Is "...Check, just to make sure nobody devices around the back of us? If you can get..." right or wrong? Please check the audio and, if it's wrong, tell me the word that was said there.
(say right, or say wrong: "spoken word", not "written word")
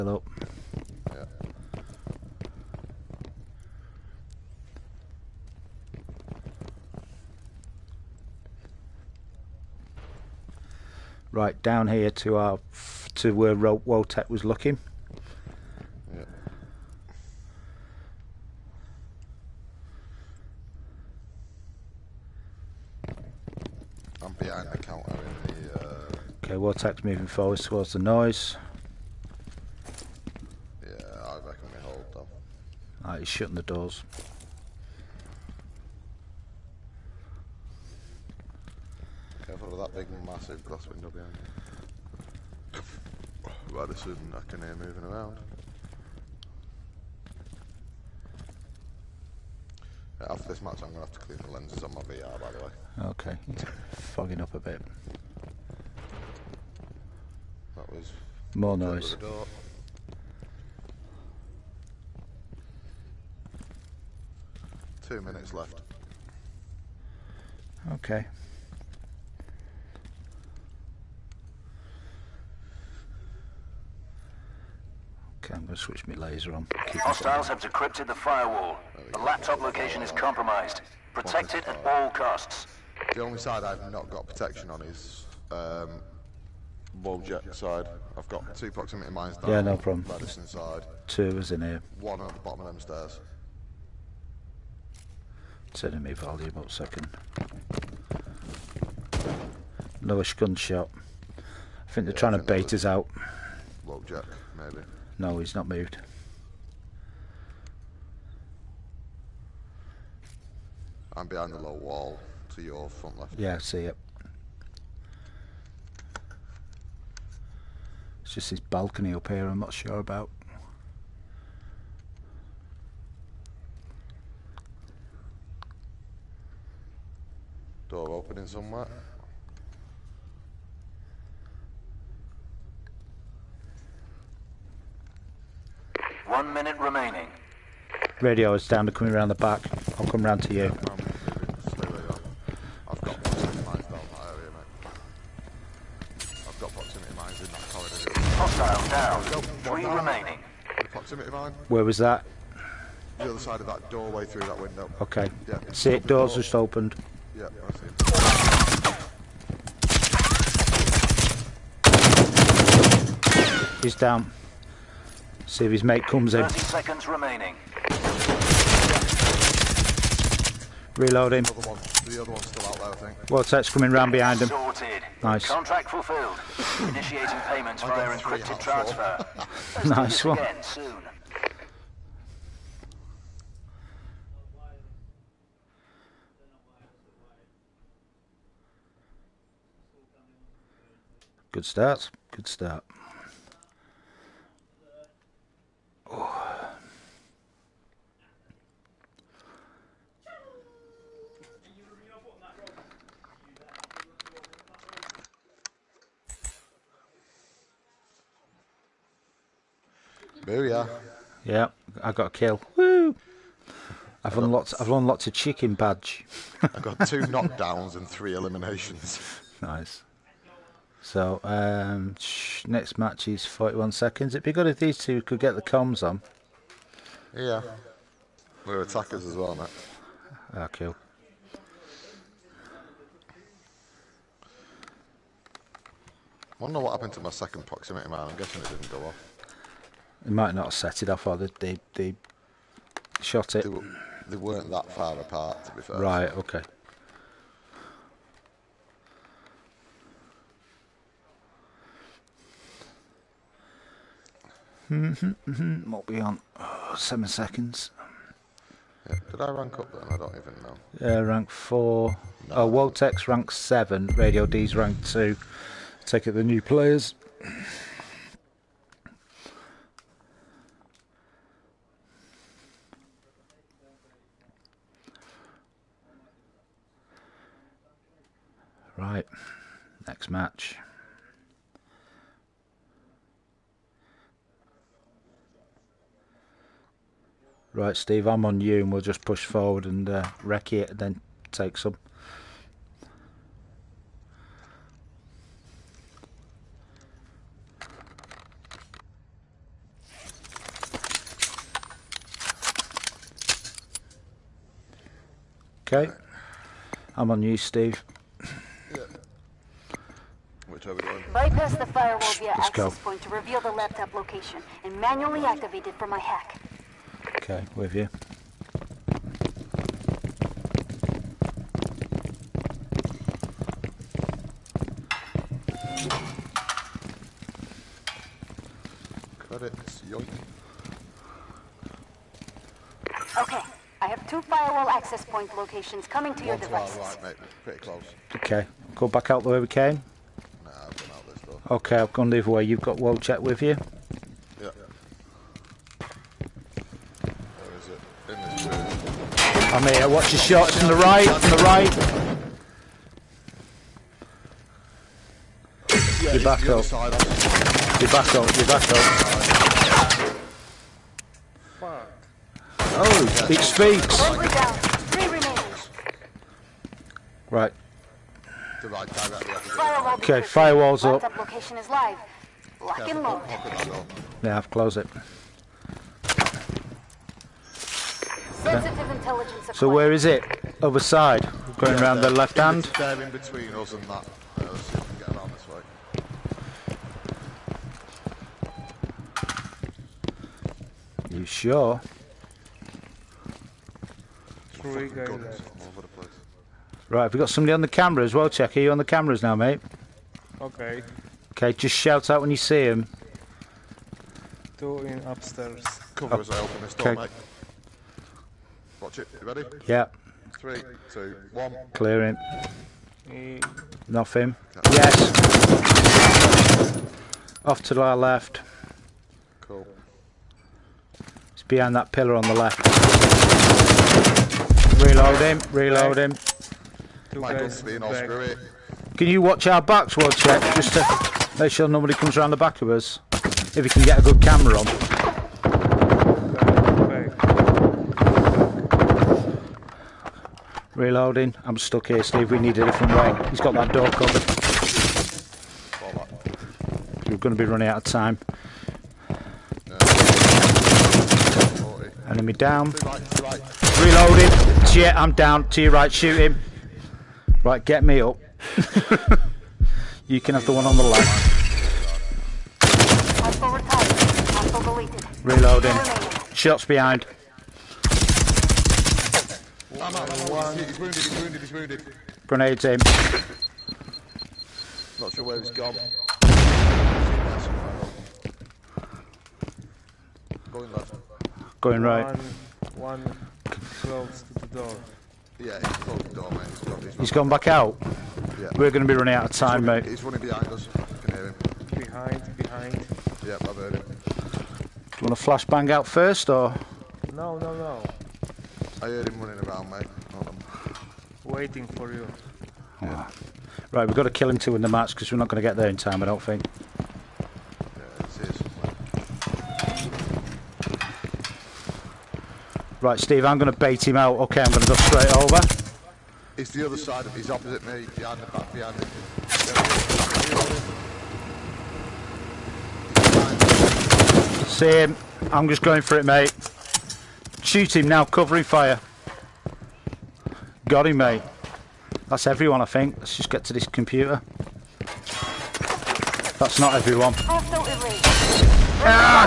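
wrong: "comes", not "devices".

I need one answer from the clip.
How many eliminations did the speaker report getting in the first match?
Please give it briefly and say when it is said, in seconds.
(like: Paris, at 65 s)
3, at 218 s.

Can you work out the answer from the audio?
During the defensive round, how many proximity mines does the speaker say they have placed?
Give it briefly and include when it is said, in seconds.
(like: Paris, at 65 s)
2, at 88 s.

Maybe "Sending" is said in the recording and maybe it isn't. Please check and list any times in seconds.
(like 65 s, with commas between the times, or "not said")
95 s.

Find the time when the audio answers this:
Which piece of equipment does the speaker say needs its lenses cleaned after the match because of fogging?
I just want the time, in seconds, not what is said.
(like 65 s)
51 s.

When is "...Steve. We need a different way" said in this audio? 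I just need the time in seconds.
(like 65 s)
442 s.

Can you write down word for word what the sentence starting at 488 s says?
We're going to be running out of time, he's running, mate.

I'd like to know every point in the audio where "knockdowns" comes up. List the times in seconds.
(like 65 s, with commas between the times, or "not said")
217 s.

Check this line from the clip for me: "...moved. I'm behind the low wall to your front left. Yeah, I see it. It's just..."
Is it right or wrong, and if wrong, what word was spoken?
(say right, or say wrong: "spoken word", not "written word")
right.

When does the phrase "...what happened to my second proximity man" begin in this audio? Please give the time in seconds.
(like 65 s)
236 s.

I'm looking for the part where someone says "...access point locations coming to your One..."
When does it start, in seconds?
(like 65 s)
334 s.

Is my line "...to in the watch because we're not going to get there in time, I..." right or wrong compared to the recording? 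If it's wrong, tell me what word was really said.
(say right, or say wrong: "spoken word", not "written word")
wrong: "match", not "watch".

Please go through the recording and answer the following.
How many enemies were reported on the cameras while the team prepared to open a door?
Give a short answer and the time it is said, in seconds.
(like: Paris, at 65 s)
3, at 394 s.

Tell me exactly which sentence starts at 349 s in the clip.
I'm here, watch your shots from the right, from the right.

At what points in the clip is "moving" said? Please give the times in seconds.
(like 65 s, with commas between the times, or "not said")
27 s, 44 s.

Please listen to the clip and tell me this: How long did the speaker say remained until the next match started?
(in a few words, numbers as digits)
41 seconds.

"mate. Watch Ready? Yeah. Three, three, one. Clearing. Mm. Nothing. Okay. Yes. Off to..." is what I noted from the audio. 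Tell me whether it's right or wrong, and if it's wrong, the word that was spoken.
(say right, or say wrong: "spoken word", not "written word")
wrong: "two", not "three".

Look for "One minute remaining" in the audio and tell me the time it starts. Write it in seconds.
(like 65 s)
136 s.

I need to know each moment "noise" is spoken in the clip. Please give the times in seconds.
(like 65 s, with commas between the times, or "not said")
27 s, 58 s.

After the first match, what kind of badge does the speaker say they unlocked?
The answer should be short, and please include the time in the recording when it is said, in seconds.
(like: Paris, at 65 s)
chicken badge, at 215 s.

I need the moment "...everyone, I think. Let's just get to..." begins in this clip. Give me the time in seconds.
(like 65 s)
532 s.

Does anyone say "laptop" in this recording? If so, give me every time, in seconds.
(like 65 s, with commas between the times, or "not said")
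79 s, 313 s.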